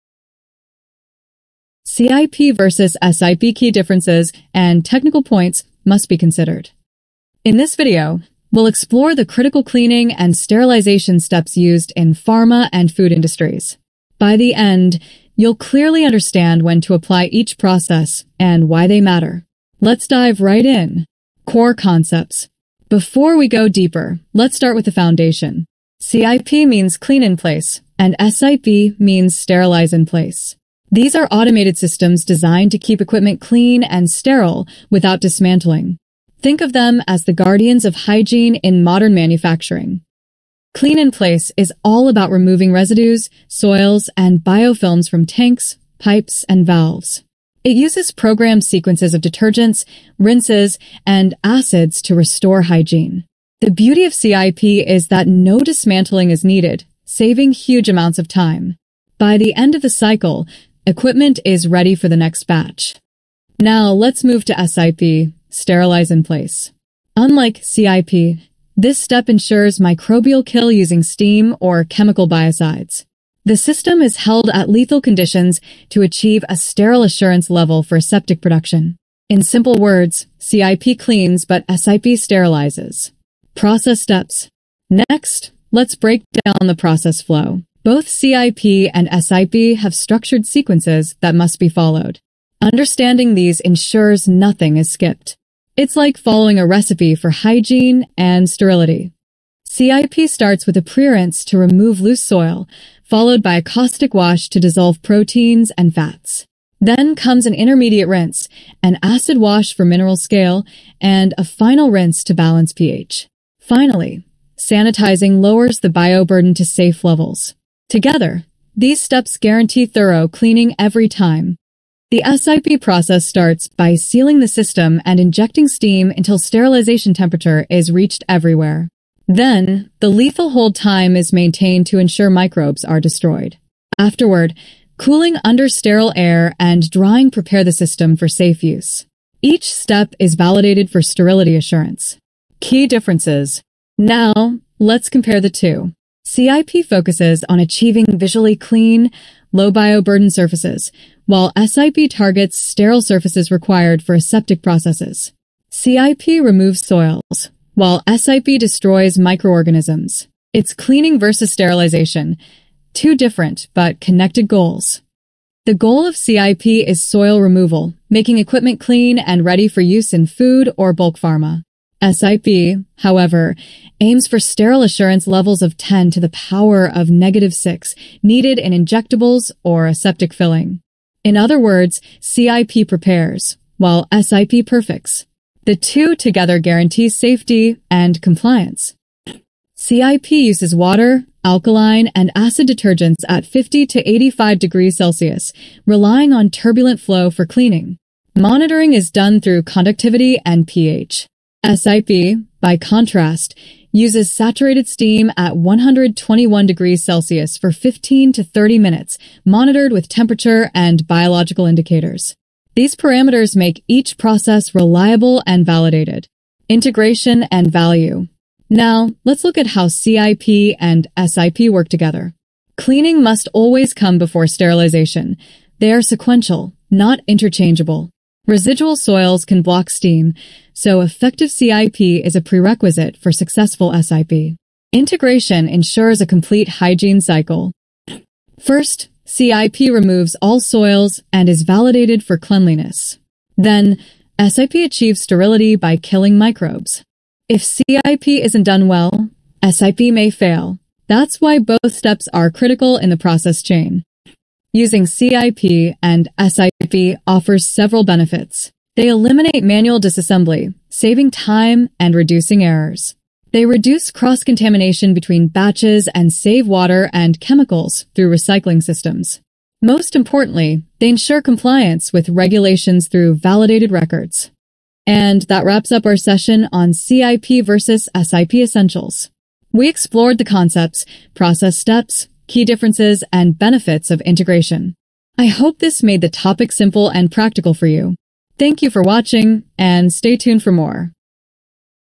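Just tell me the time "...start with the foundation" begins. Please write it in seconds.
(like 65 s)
24 s.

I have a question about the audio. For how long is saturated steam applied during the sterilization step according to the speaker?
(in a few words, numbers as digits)
15 to 30 minutes.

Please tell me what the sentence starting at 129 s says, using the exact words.
Then, the lethal hold time is maintained to ensure microbes are destroyed.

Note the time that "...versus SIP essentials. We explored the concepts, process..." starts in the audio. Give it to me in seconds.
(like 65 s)
277 s.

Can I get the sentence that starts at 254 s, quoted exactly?
Using CIP and SIP offers several benefits.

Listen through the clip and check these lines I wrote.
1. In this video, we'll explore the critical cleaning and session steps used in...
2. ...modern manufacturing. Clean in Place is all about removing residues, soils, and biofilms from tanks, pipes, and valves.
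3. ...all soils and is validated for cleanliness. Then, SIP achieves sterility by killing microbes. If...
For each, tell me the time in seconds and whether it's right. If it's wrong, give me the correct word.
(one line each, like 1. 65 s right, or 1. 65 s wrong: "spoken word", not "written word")
1. 7 s wrong: "sterilization", not "session"
2. 38 s right
3. 240 s right.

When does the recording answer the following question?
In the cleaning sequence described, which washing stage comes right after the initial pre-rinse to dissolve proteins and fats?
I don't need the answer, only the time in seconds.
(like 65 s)
103 s.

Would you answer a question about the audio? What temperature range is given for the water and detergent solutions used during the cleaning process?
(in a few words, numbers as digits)
50 to 85 degrees Celsius.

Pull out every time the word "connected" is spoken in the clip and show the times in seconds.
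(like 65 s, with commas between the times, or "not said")
163 s.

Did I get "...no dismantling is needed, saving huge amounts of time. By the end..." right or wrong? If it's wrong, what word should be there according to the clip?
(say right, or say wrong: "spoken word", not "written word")
right.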